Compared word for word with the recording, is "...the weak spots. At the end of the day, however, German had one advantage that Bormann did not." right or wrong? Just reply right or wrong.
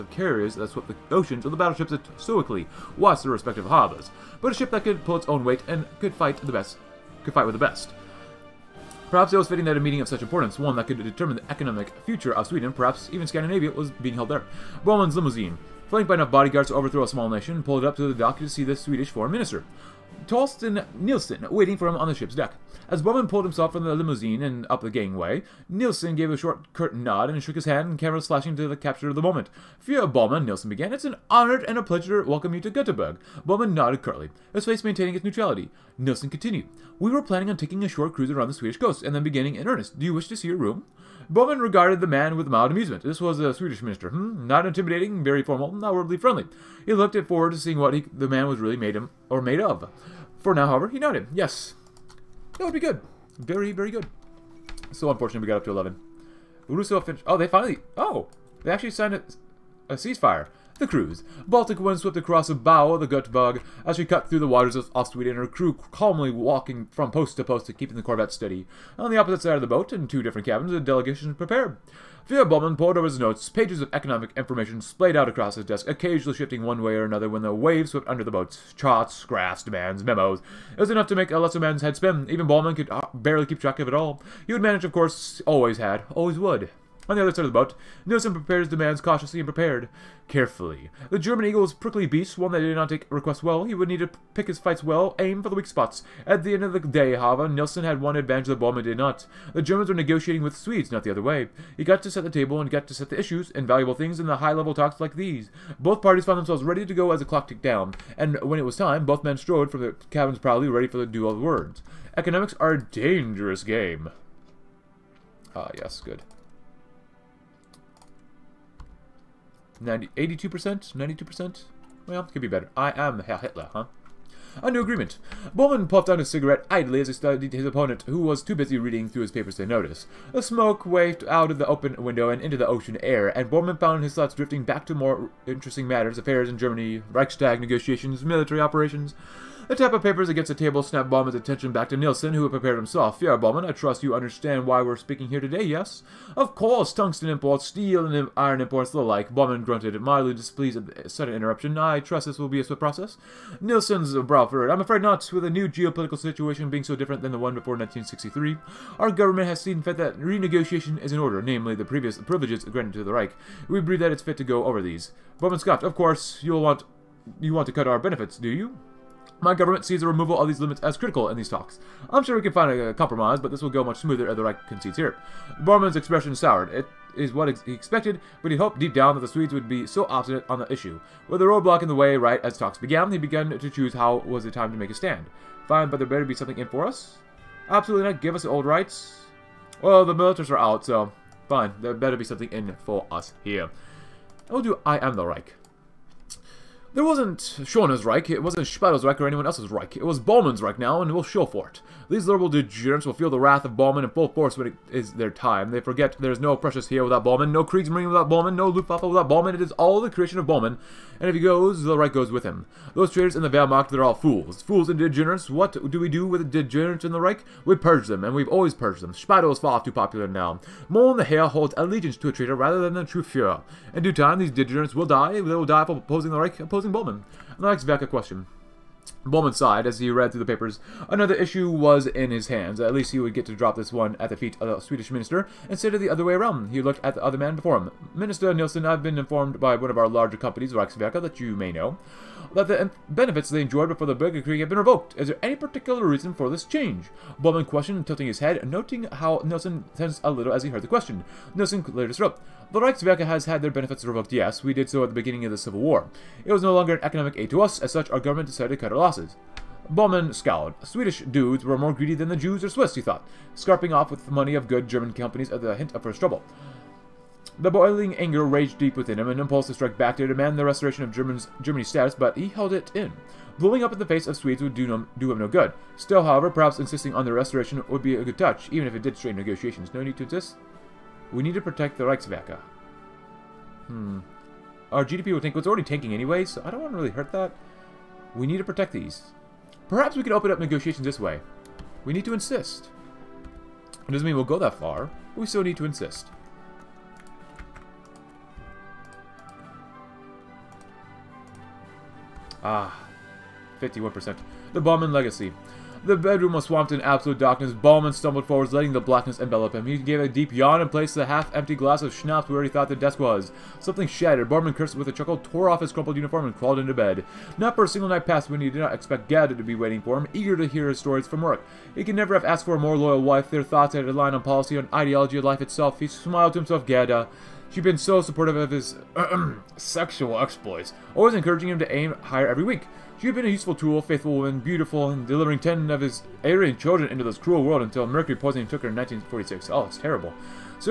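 wrong.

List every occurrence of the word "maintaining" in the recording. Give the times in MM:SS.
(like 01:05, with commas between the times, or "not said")
00:34.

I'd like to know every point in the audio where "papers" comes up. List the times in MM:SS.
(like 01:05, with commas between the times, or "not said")
02:09, 02:20, 03:50.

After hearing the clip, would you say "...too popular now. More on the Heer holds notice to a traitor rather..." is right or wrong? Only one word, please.
wrong.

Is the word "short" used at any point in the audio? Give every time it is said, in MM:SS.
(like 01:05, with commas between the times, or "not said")
00:26, 00:37.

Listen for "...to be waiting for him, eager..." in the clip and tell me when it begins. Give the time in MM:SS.
05:19.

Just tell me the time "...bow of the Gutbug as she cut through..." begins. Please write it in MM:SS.
01:02.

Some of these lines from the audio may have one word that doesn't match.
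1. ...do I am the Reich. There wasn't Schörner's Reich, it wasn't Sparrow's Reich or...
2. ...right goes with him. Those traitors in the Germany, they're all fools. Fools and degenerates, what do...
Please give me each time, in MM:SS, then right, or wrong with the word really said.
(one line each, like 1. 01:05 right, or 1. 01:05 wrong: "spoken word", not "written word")
1. 03:14 right
2. 03:31 wrong: "Wehrmacht", not "Germany".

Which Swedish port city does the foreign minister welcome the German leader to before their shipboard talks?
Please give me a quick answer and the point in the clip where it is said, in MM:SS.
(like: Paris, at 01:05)
Göteborg, at 00:32.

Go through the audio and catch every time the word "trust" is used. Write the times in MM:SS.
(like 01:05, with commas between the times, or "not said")
02:23, 02:31.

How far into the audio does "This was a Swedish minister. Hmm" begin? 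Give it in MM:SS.
00:43.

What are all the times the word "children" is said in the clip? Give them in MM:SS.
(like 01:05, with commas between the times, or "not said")
05:36.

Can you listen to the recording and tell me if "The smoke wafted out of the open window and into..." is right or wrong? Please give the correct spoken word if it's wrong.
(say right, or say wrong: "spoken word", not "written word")
right.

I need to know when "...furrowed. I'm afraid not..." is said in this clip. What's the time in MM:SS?
02:34.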